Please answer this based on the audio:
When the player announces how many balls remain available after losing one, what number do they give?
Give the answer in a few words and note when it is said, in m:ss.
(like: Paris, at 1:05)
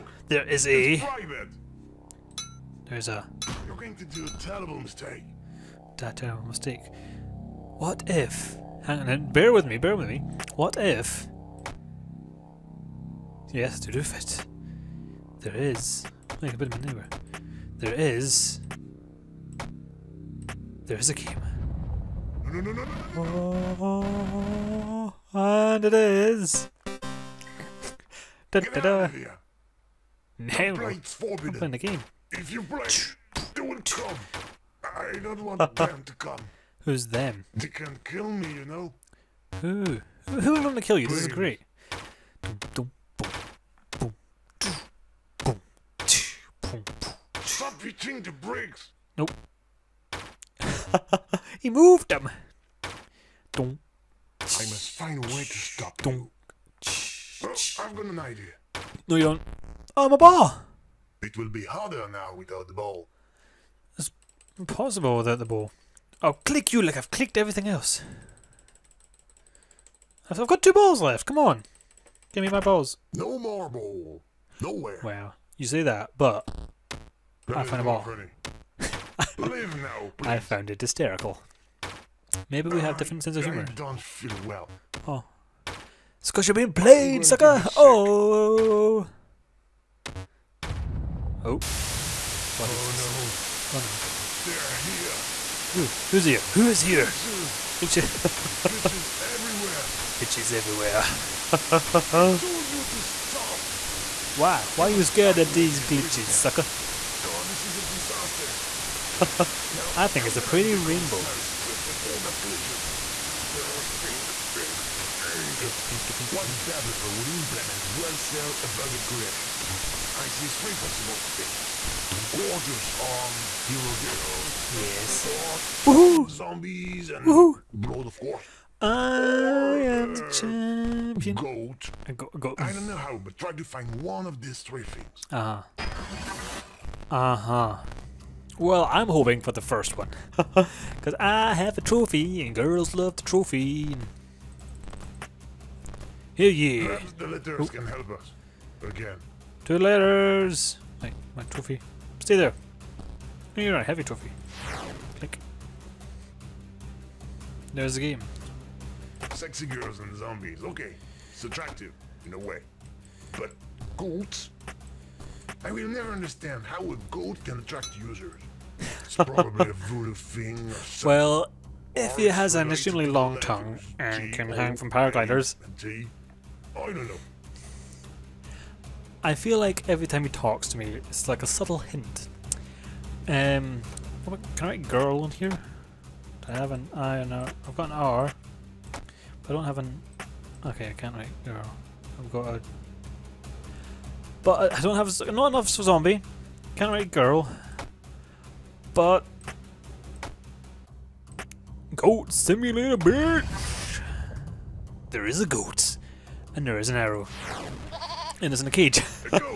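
2, at 1:10.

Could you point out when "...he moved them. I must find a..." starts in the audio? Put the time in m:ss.
0:51.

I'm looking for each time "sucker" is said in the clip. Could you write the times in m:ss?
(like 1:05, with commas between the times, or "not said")
1:27, 1:46.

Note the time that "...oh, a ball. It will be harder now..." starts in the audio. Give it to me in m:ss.
1:00.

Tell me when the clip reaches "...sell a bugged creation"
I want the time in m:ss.
1:58.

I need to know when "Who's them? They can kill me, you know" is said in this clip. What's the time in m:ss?
0:36.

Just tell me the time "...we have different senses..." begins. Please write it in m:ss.
1:22.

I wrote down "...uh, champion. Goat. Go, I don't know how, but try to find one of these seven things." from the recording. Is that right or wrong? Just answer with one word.
wrong.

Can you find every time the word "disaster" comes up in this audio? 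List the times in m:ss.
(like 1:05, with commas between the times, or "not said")
1:47.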